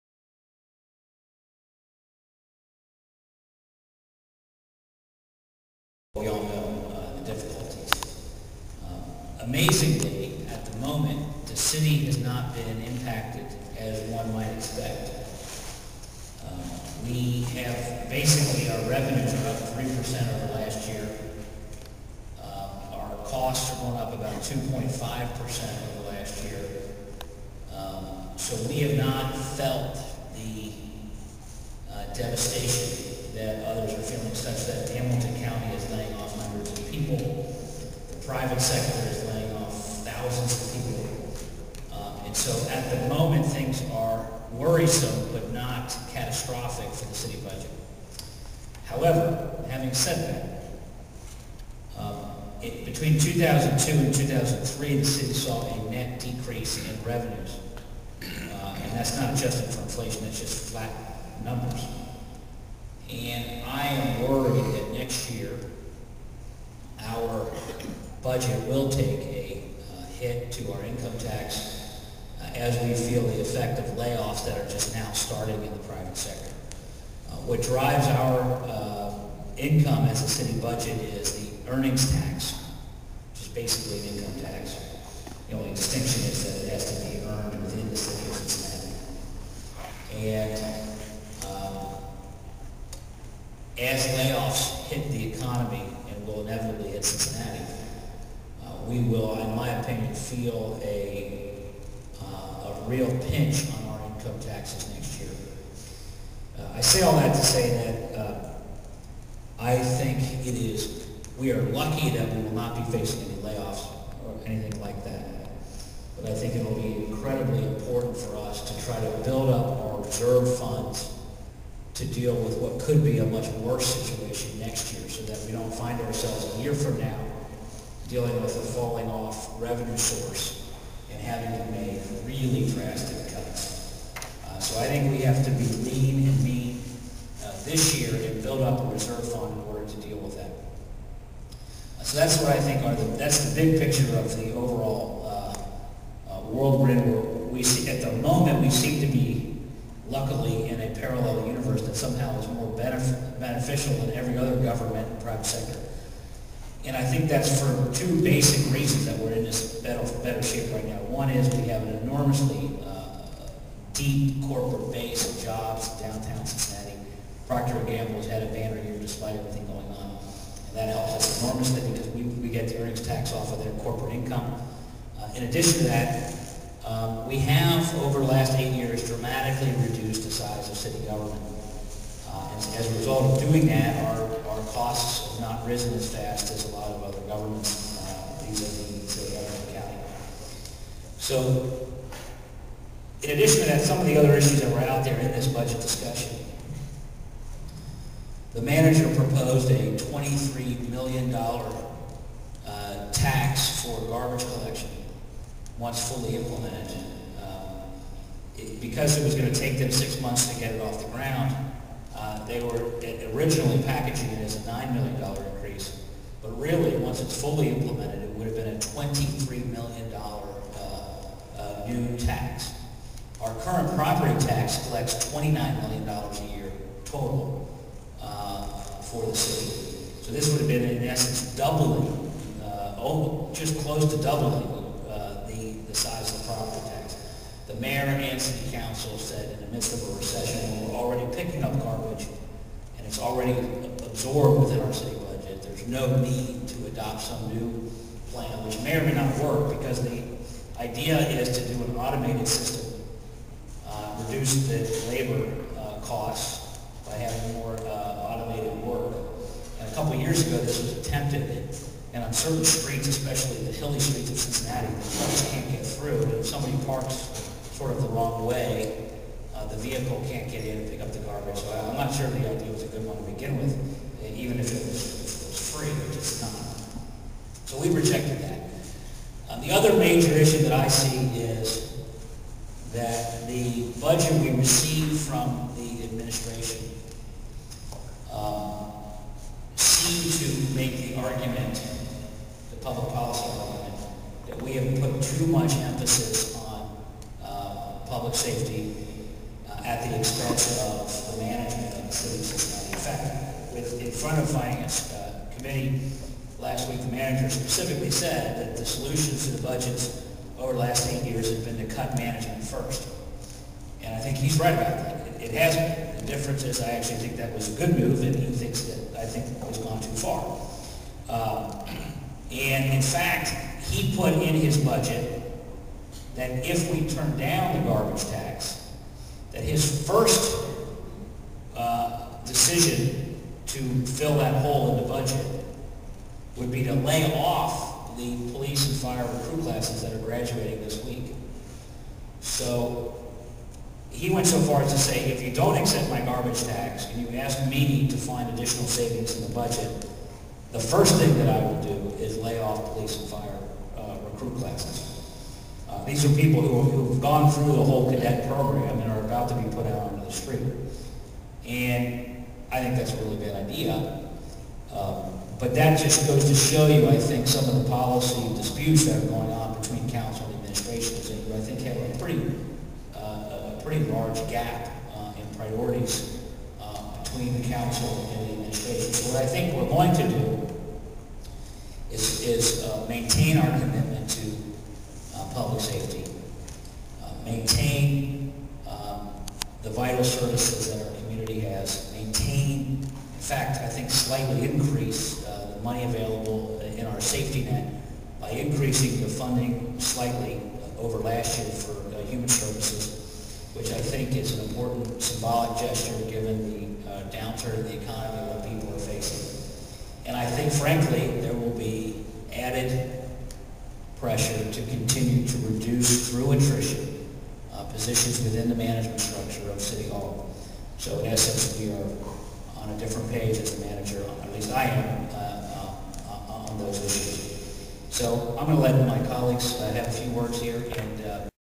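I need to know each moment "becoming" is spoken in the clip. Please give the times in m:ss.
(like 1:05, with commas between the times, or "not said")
not said.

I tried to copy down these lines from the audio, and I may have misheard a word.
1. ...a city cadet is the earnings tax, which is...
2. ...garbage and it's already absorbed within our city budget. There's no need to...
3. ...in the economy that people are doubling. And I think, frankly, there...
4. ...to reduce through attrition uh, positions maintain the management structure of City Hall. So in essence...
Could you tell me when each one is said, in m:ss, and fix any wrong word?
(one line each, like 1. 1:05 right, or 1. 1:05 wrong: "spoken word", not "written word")
1. 1:20 wrong: "budget", not "cadet"
2. 4:01 right
3. 6:47 wrong: "facing", not "doubling"
4. 6:55 wrong: "within", not "maintain".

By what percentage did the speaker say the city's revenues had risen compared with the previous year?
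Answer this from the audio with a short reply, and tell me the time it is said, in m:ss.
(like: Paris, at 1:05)
3%, at 0:19.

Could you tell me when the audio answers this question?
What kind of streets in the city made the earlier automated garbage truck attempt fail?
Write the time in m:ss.
4:23.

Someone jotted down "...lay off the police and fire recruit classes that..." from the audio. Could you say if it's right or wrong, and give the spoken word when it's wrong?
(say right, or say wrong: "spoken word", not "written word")
right.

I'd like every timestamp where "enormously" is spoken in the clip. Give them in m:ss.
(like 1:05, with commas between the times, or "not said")
2:42, 2:51.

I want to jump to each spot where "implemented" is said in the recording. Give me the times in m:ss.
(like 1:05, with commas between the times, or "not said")
3:26, 3:37.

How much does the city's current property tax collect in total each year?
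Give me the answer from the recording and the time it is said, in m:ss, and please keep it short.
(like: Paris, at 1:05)
$29 million, at 3:45.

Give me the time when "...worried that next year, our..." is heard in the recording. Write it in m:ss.
1:04.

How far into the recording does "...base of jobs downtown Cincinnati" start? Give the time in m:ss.
2:44.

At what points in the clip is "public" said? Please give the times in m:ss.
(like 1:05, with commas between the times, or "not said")
4:52, 4:58, 6:25.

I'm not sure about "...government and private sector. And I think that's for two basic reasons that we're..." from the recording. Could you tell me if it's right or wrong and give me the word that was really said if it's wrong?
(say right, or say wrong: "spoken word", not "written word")
right.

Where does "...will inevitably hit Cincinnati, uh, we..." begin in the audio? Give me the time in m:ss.
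1:36.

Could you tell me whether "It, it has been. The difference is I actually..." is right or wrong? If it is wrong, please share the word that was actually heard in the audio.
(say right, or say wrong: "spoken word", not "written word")
right.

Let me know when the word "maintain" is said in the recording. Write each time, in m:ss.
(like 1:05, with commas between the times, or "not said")
6:23, 6:27, 6:32.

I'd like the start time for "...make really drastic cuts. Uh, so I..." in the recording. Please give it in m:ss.
2:11.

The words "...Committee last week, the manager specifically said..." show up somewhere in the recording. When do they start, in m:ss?
5:05.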